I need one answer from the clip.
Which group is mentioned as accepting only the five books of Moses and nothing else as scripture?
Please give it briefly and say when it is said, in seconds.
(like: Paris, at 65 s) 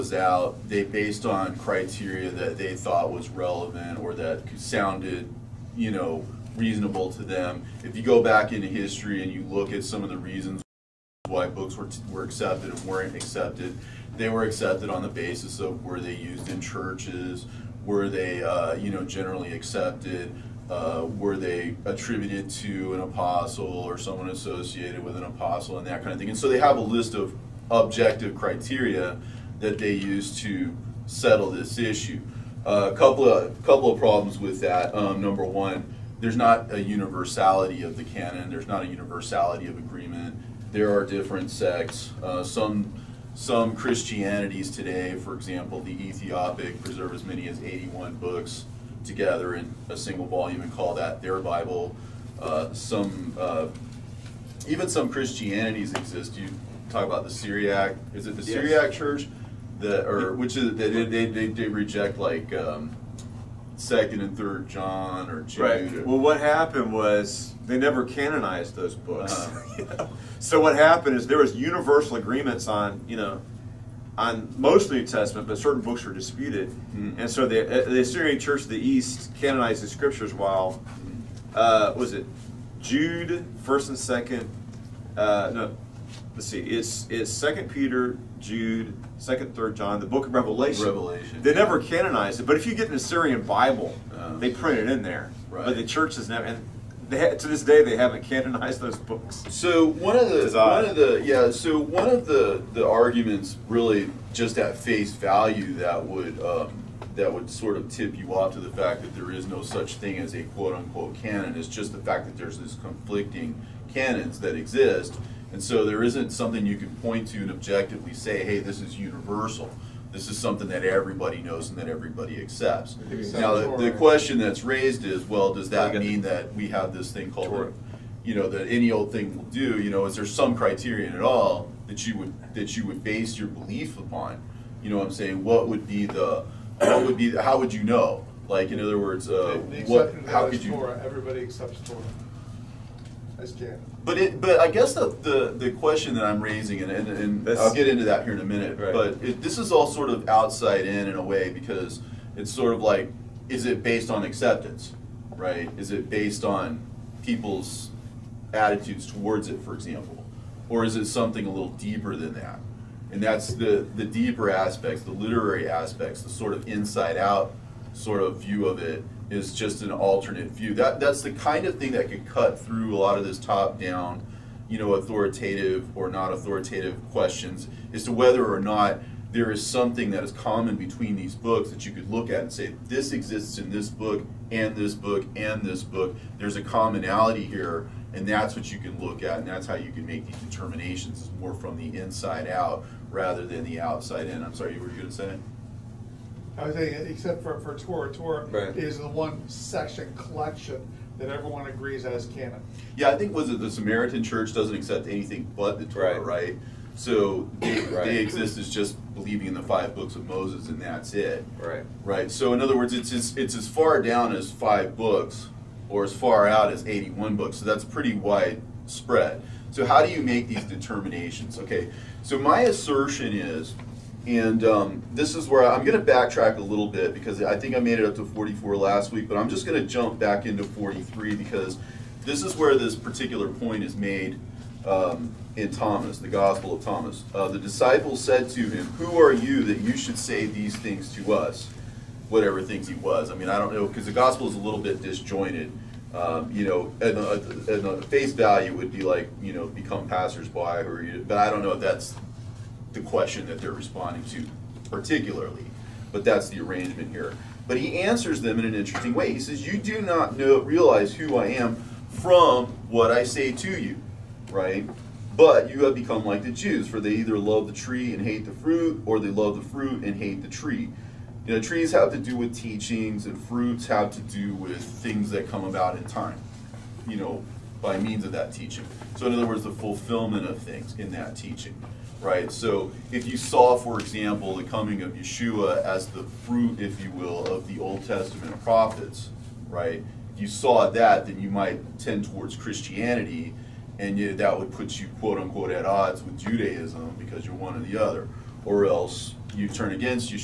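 Samaritan Church, at 203 s.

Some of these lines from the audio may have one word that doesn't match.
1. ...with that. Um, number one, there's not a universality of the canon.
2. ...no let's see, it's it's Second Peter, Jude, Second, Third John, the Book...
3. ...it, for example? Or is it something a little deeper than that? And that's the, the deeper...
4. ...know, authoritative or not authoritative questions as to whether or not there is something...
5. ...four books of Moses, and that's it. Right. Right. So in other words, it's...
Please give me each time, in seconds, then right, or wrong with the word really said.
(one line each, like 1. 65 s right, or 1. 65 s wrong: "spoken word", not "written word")
1. 34 s right
2. 85 s right
3. 159 s right
4. 174 s right
5. 209 s wrong: "five", not "four".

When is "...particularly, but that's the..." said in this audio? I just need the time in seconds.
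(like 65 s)
254 s.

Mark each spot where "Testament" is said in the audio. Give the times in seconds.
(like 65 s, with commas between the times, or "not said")
75 s, 288 s.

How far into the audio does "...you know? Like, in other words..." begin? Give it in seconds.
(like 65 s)
137 s.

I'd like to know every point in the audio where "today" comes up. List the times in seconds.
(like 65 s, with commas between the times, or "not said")
44 s.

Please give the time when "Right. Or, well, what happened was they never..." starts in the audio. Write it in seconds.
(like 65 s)
65 s.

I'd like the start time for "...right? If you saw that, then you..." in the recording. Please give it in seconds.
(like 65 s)
289 s.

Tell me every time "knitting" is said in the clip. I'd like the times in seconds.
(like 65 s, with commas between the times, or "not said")
not said.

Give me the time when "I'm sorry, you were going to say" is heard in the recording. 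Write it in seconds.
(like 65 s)
194 s.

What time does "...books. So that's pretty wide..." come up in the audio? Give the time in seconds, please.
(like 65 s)
217 s.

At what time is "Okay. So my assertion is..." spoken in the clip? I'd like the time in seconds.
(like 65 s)
221 s.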